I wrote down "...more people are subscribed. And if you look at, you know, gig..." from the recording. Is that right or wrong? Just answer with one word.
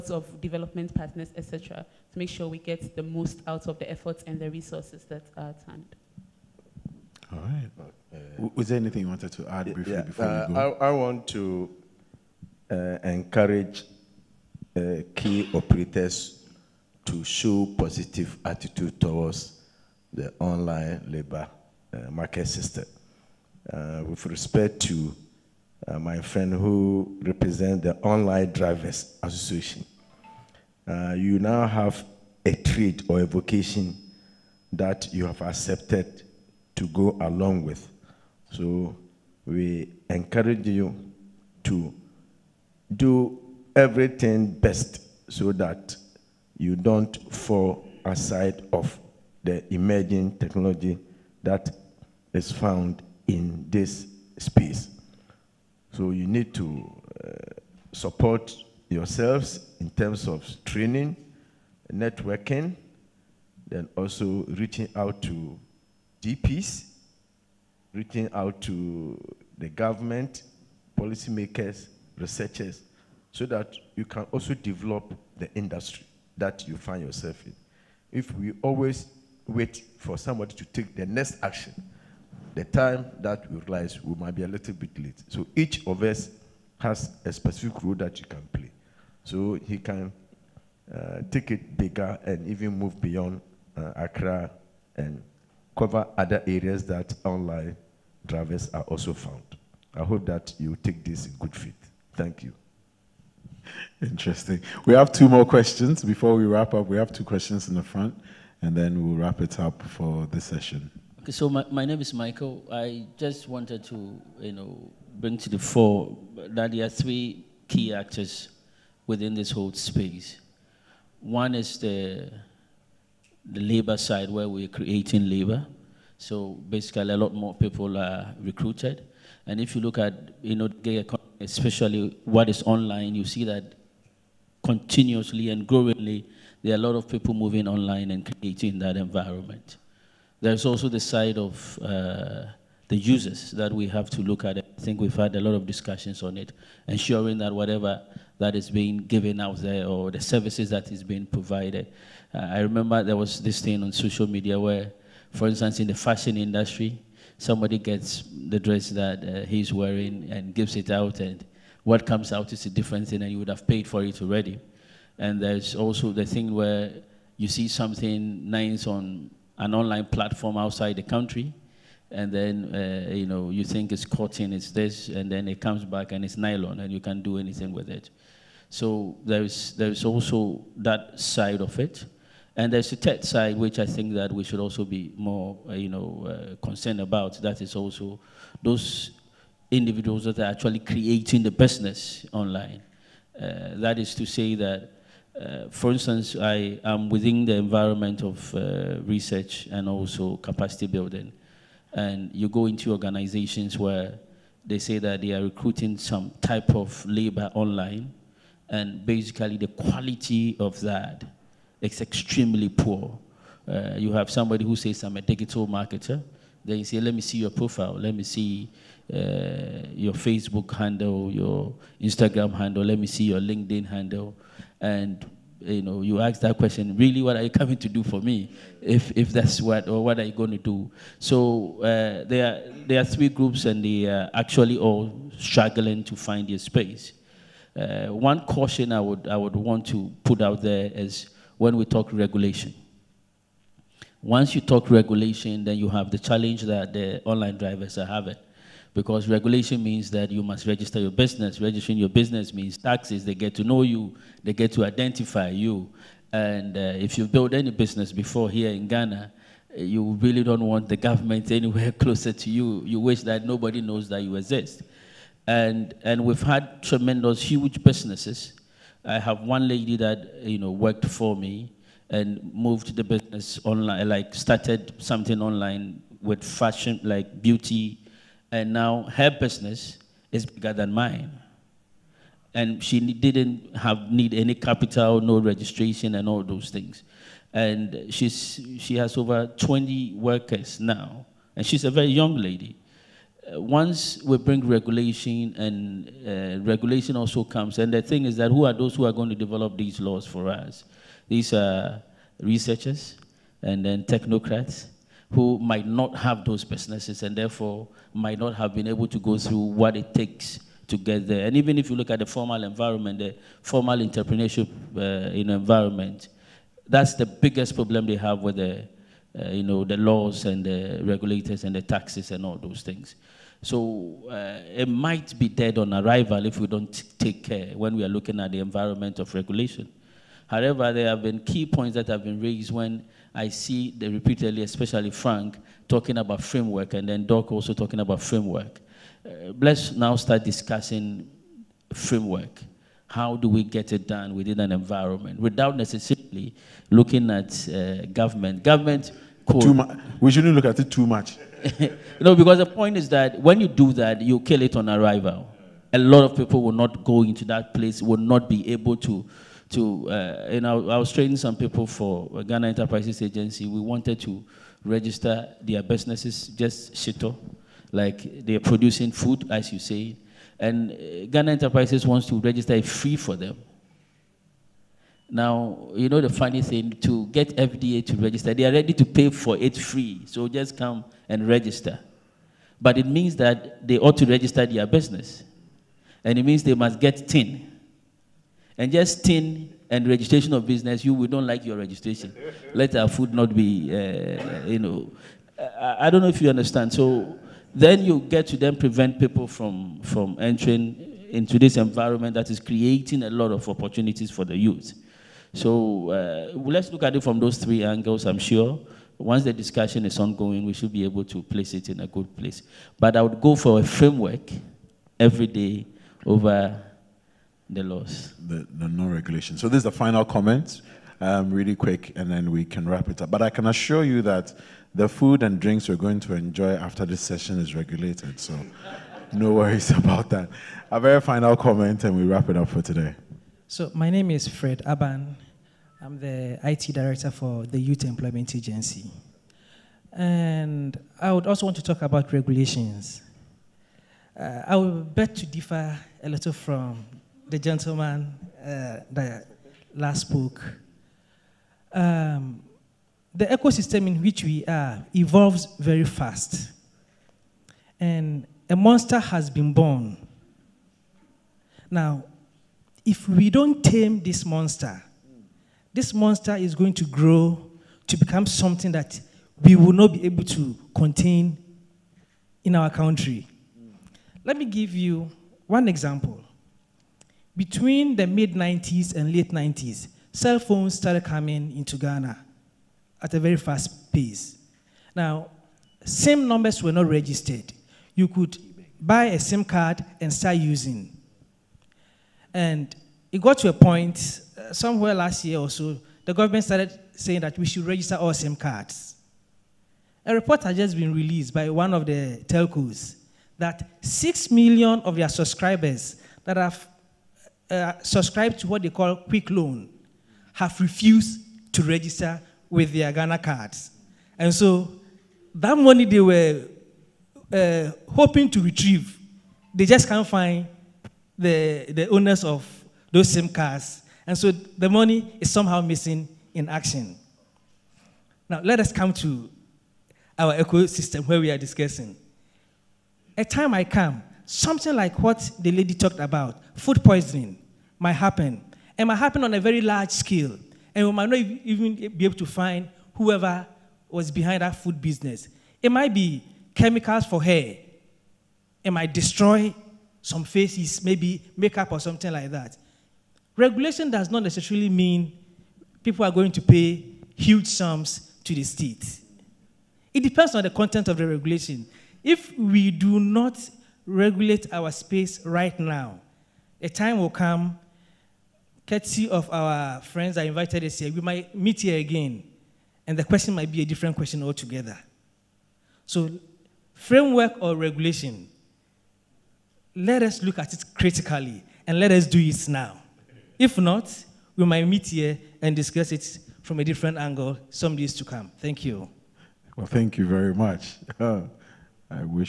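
wrong.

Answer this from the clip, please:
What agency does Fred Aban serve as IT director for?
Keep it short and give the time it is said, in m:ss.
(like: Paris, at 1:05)
Youth Employment Agency, at 7:17.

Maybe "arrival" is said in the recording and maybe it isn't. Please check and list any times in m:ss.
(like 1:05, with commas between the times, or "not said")
5:25, 5:54.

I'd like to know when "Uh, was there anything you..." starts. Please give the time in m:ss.
0:07.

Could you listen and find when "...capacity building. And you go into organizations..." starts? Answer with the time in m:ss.
3:20.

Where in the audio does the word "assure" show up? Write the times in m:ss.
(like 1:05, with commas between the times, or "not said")
7:03.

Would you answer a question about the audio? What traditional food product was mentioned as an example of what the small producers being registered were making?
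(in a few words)
Shito.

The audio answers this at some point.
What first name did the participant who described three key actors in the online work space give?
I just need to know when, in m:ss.
1:52.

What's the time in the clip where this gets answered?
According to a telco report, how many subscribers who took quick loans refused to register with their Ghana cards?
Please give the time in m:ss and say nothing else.
8:24.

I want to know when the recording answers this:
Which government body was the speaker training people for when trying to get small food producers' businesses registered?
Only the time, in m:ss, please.
6:02.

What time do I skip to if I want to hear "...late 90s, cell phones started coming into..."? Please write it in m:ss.
7:59.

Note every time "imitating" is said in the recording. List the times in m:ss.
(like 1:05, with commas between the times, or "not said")
not said.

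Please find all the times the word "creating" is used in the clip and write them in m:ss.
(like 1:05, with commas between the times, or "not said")
2:04, 2:18, 3:10, 6:42.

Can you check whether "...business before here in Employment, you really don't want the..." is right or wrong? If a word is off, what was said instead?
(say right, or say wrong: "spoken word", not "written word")
wrong: "Ghana", not "Employment".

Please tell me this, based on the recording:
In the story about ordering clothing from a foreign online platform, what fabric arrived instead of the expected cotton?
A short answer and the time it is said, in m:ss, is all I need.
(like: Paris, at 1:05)
Nylon, at 2:56.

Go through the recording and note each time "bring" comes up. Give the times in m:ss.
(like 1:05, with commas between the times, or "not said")
1:55, 4:54.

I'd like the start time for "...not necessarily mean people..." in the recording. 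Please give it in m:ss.
9:14.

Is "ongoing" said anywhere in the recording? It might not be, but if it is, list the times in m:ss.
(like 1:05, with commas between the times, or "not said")
6:50.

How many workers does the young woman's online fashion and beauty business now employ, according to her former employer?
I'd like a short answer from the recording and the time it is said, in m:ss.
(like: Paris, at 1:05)
Over 20, at 4:49.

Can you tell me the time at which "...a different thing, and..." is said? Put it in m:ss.
2:42.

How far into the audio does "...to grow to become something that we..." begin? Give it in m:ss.
7:46.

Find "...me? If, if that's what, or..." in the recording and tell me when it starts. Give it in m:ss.
3:48.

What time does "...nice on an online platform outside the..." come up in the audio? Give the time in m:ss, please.
2:48.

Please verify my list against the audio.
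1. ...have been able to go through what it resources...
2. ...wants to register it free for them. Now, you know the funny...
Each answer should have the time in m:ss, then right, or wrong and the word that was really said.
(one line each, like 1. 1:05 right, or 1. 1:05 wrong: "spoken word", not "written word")
1. 5:08 wrong: "takes", not "resources"
2. 6:12 right.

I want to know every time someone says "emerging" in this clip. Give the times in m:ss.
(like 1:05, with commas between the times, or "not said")
0:49.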